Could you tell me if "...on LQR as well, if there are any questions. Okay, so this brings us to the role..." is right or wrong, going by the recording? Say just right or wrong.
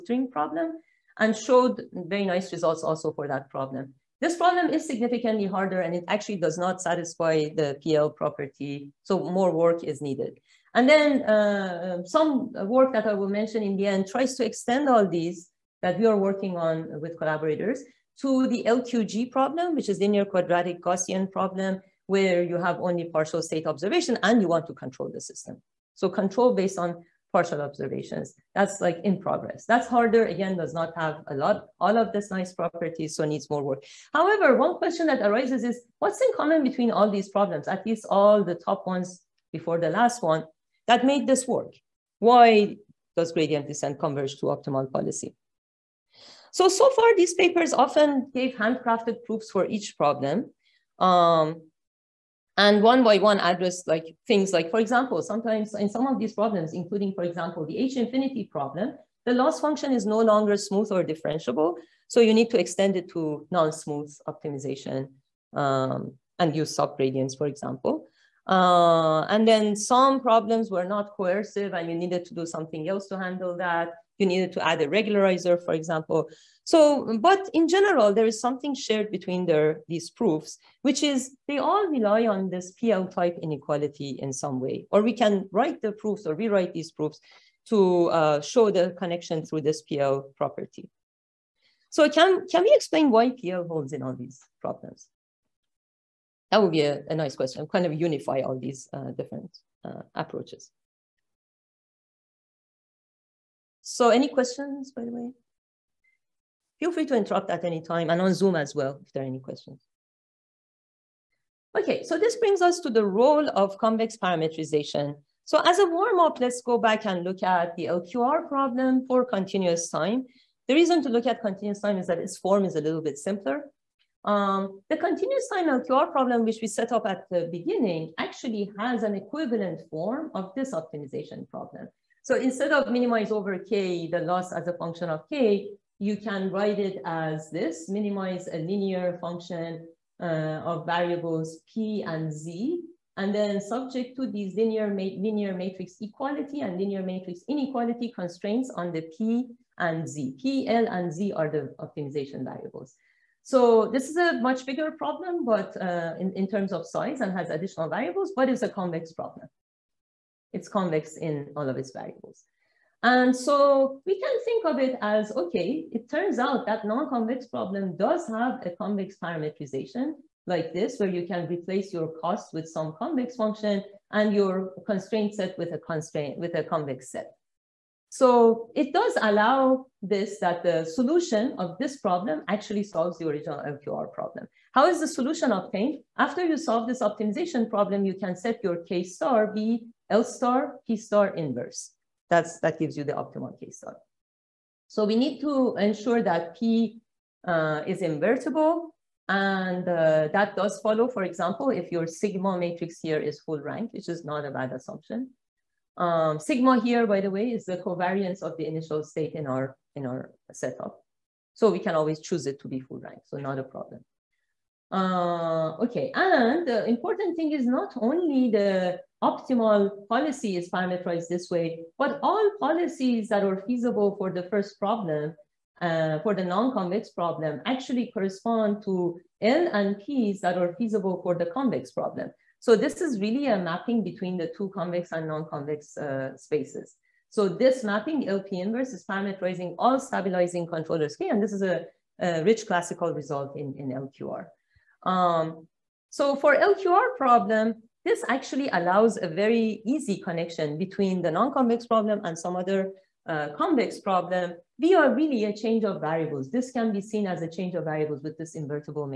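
wrong.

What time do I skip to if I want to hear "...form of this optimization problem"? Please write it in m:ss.
2:09.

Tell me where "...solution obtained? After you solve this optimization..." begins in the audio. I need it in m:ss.
3:05.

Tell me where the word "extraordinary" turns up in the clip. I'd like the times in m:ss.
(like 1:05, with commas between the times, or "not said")
not said.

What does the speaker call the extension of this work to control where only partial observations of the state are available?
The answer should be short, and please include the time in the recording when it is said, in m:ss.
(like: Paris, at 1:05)
linear quadratic Gaussian problem, at 0:19.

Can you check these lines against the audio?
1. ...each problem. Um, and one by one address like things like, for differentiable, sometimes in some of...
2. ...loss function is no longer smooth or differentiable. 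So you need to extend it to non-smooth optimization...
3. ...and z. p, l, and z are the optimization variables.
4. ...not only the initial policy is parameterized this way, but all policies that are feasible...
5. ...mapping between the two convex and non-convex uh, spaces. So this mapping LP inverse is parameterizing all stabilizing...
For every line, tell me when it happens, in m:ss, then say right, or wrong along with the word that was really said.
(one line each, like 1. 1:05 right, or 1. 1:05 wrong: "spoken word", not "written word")
1. 0:49 wrong: "example", not "differentiable"
2. 0:59 right
3. 2:29 right
4. 3:37 wrong: "optimal", not "initial"
5. 3:53 right.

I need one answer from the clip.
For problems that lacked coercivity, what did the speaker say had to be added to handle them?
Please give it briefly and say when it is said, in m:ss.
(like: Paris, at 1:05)
a regularizer, at 1:14.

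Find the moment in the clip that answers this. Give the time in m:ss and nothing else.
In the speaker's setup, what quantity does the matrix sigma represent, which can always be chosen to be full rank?
3:27.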